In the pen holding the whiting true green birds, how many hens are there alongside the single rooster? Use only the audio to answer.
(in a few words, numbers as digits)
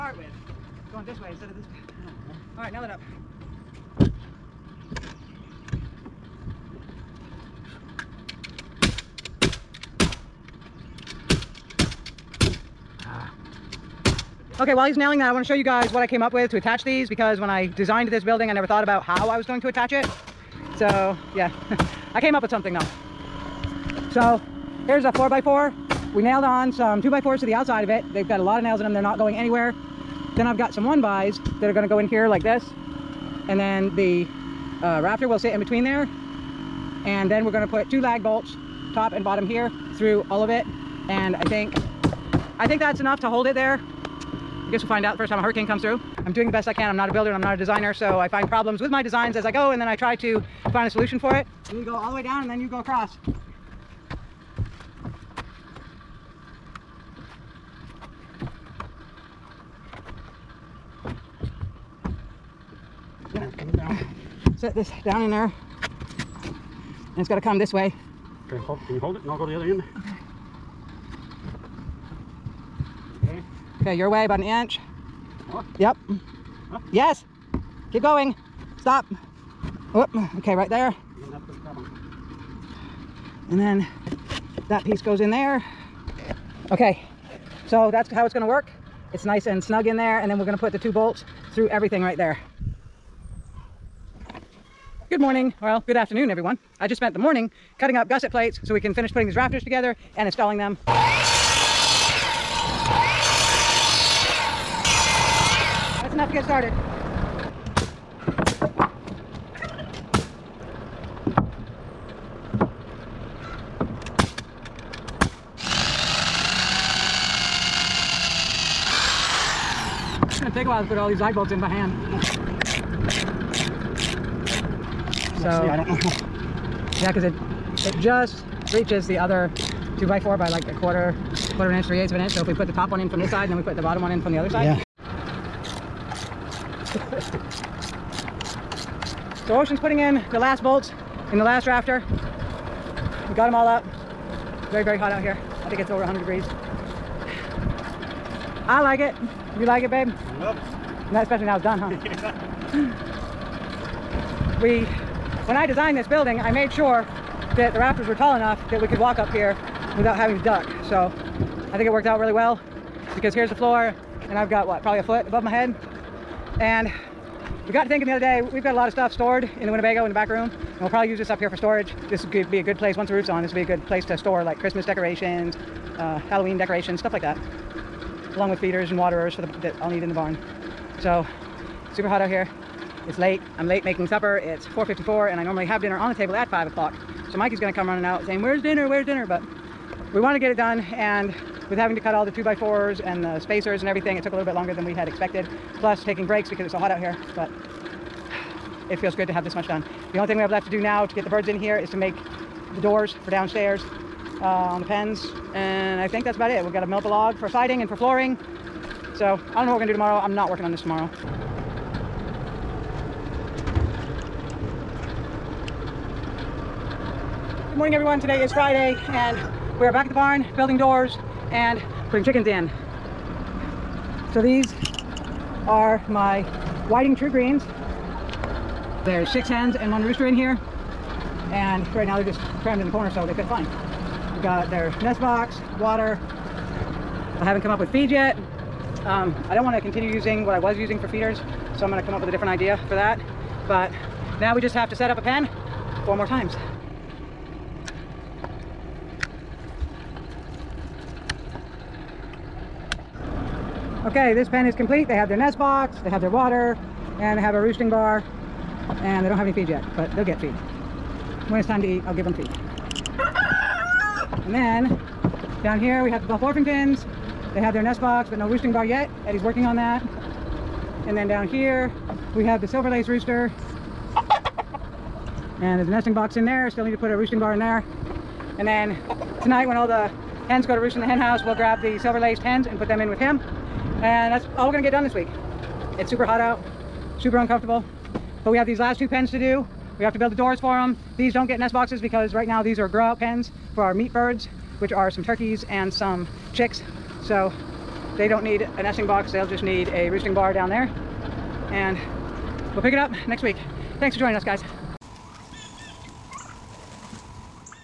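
6.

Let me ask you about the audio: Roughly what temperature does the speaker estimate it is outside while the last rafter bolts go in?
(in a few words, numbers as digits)
over 100 degrees.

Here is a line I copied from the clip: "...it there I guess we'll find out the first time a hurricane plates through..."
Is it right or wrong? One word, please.
wrong.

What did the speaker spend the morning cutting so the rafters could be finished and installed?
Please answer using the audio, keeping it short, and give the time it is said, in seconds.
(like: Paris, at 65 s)
gusset plates, at 98 s.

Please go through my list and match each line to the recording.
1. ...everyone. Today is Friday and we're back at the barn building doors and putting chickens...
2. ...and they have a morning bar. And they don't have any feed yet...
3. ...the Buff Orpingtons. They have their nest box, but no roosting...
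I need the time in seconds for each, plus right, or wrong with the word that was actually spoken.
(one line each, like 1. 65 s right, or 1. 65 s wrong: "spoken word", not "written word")
1. 217 s right
2. 257 s wrong: "roosting", not "morning"
3. 266 s right.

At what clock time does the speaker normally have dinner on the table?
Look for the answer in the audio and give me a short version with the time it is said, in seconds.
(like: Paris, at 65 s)
5 o'clock, at 186 s.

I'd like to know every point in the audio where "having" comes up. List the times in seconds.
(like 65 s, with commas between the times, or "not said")
160 s, 191 s.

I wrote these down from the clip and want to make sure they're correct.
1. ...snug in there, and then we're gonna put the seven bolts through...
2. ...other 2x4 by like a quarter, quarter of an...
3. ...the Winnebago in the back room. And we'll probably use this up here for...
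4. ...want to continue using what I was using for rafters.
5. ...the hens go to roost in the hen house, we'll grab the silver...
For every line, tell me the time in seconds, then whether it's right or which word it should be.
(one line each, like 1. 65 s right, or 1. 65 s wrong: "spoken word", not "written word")
1. 89 s wrong: "two", not "seven"
2. 129 s right
3. 169 s right
4. 239 s wrong: "feeders", not "rafters"
5. 279 s right.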